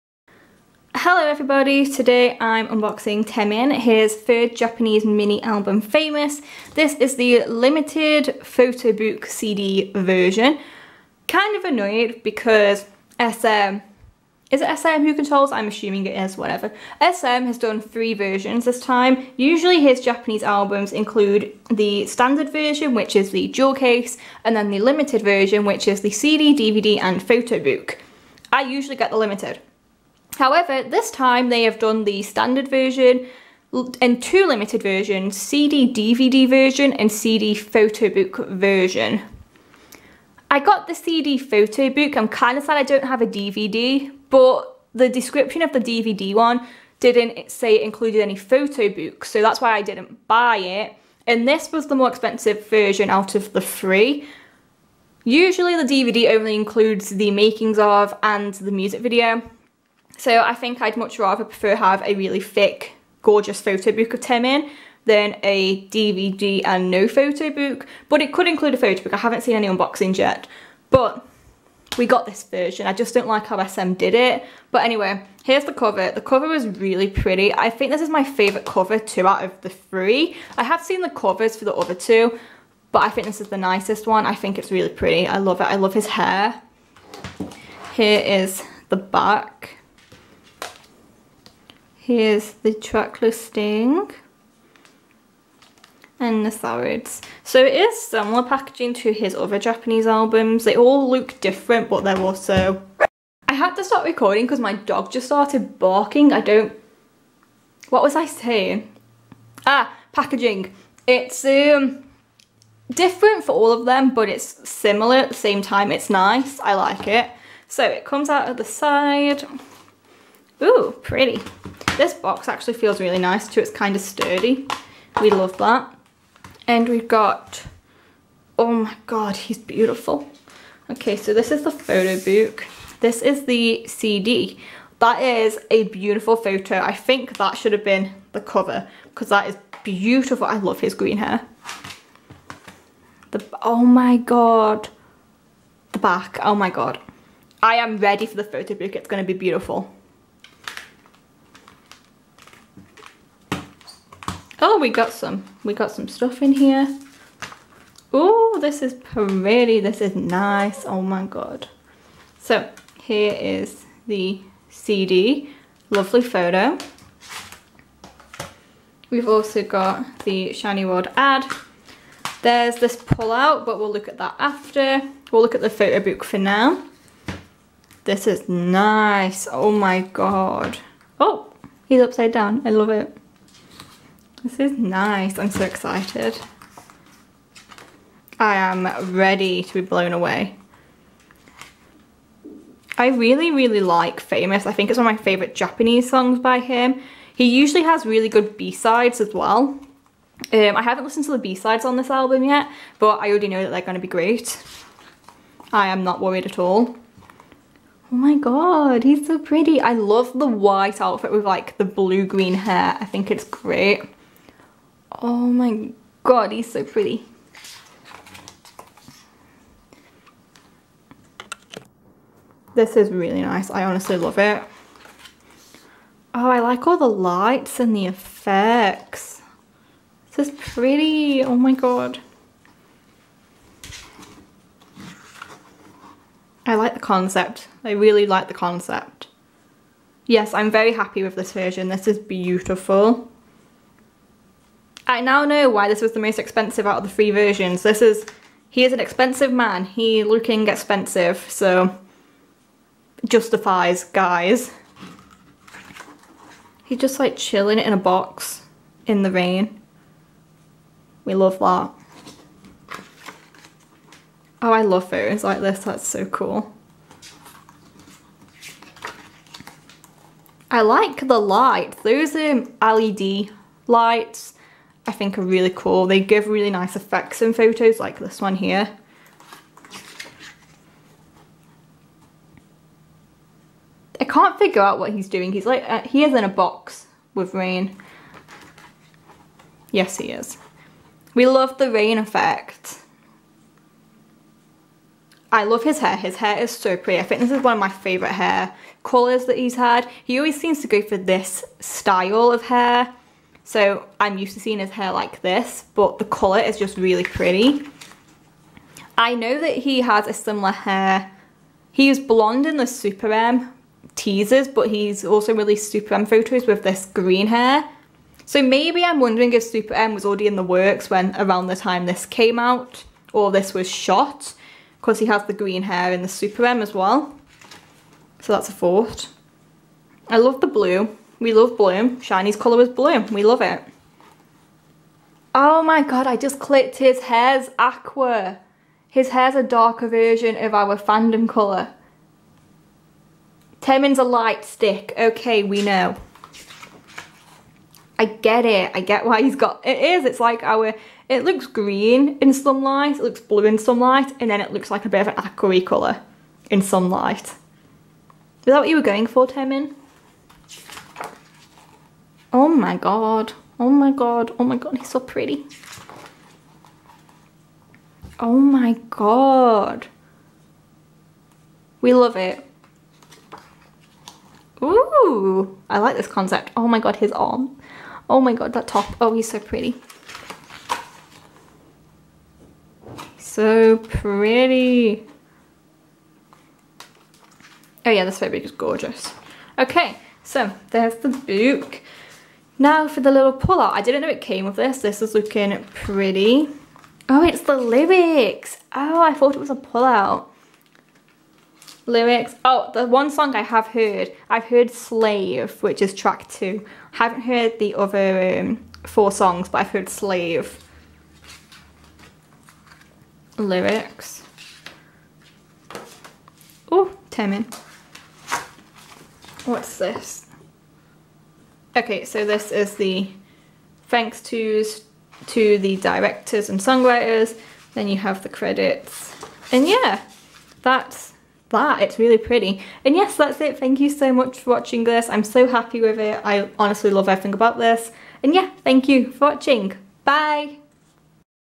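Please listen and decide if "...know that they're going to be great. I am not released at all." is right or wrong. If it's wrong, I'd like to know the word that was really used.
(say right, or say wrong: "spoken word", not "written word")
wrong: "worried", not "released".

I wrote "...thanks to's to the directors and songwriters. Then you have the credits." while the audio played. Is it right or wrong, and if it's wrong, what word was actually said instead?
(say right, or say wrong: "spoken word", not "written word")
right.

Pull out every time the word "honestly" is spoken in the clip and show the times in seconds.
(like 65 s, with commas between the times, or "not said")
223 s, 436 s.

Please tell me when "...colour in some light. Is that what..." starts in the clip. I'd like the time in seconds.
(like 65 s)
355 s.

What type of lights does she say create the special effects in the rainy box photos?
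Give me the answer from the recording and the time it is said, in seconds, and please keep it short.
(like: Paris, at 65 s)
LED lights, at 272 s.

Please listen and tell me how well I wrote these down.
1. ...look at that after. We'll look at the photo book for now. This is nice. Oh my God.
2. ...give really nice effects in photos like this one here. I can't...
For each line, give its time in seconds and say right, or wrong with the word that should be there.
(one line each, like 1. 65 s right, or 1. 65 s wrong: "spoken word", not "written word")
1. 173 s right
2. 276 s right.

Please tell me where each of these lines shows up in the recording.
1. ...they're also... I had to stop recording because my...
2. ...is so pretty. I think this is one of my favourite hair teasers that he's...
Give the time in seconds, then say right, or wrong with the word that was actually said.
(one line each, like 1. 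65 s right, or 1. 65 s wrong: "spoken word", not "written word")
1. 102 s right
2. 296 s wrong: "colours", not "teasers".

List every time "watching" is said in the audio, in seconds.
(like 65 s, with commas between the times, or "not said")
434 s, 439 s.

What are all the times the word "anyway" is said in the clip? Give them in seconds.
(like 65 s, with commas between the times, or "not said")
74 s.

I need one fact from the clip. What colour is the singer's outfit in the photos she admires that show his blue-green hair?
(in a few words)
White.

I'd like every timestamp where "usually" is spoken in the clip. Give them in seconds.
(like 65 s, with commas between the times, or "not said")
19 s, 28 s, 55 s, 197 s.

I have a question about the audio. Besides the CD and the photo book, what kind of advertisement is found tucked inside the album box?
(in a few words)
SHINee World ad.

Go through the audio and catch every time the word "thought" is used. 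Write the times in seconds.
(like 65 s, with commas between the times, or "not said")
328 s, 399 s.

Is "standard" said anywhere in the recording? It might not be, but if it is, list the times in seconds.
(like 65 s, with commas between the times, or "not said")
22 s, 32 s.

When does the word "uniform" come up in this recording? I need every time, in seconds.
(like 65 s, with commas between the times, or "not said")
not said.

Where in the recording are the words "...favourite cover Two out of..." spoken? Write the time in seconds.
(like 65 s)
78 s.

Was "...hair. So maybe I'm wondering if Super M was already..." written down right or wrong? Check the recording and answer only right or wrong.
right.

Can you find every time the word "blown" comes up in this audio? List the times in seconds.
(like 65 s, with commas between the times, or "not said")
189 s.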